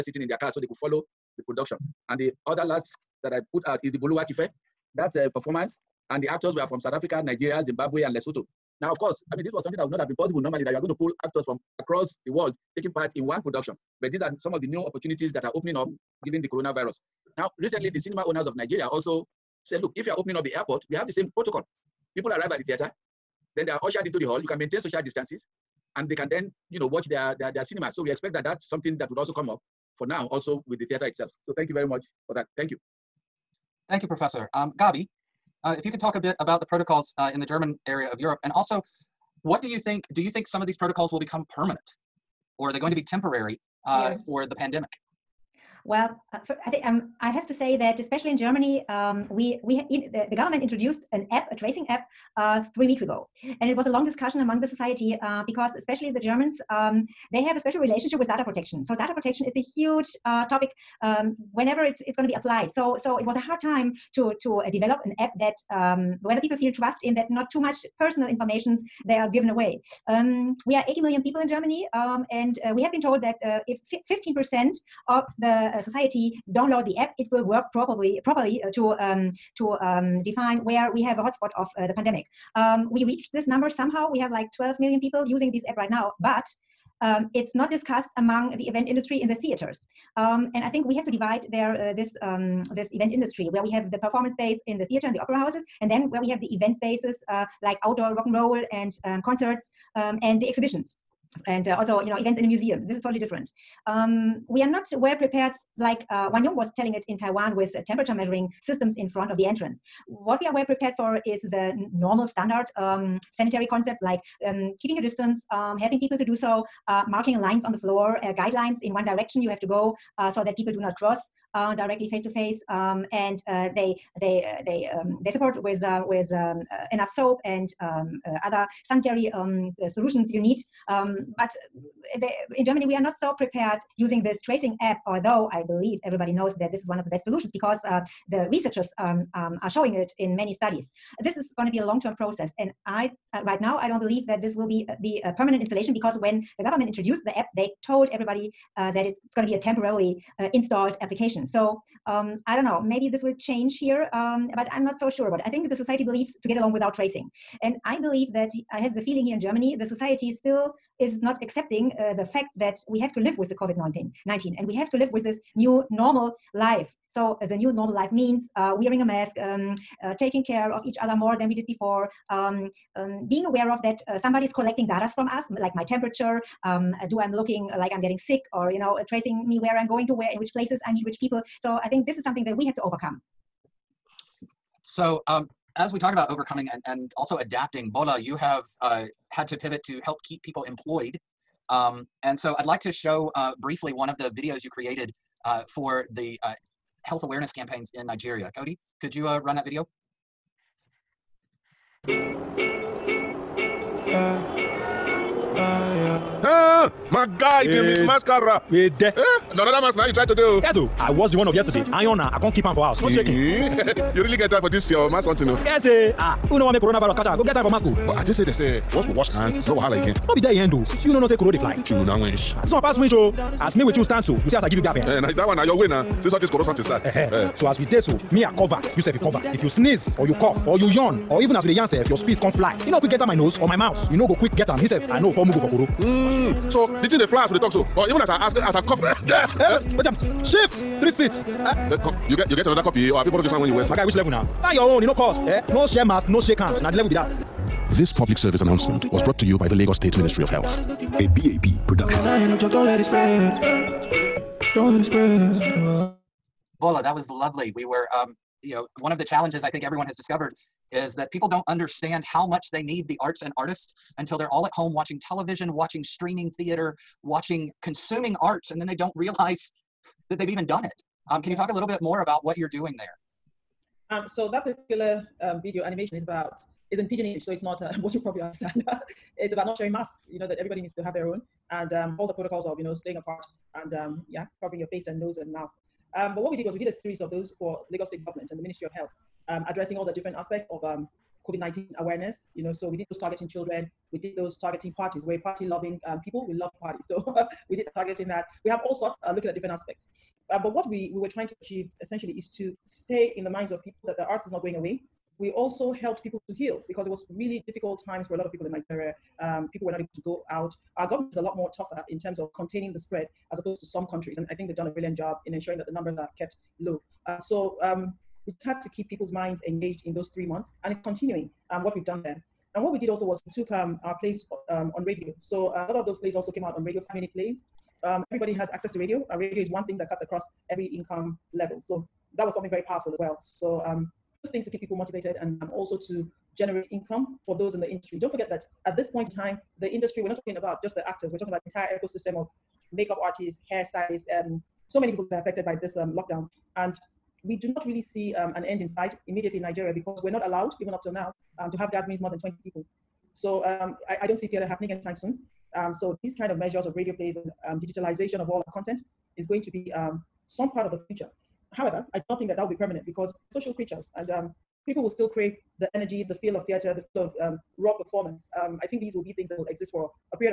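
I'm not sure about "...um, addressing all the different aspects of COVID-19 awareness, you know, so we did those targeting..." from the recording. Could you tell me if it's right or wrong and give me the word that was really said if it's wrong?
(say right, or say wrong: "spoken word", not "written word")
right.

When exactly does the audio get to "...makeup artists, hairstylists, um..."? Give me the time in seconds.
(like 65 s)
342 s.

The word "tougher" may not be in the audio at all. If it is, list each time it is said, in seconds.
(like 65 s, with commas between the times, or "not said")
311 s.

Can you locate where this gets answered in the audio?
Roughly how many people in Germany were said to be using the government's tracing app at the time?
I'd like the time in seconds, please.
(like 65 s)
84 s.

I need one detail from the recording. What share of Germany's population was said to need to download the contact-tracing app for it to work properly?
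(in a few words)
15%.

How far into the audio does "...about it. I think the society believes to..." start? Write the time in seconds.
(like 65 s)
155 s.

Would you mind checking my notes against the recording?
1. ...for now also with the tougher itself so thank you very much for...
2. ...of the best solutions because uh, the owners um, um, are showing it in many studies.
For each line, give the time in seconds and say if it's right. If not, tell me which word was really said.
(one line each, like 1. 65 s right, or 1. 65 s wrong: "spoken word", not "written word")
1. 29 s wrong: "theater", not "tougher"
2. 136 s wrong: "researchers", not "owners".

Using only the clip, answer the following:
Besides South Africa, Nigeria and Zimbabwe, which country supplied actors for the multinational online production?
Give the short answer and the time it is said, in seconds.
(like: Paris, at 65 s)
Lesotho, at 8 s.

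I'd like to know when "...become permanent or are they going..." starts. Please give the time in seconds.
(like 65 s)
41 s.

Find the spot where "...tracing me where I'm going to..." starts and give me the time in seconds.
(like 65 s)
179 s.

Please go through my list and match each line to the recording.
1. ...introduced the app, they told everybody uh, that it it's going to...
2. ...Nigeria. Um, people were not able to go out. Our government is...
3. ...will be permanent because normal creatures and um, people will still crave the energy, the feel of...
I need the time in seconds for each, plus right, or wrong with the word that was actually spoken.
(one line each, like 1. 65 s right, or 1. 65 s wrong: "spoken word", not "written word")
1. 146 s right
2. 308 s right
3. 362 s wrong: "social", not "normal".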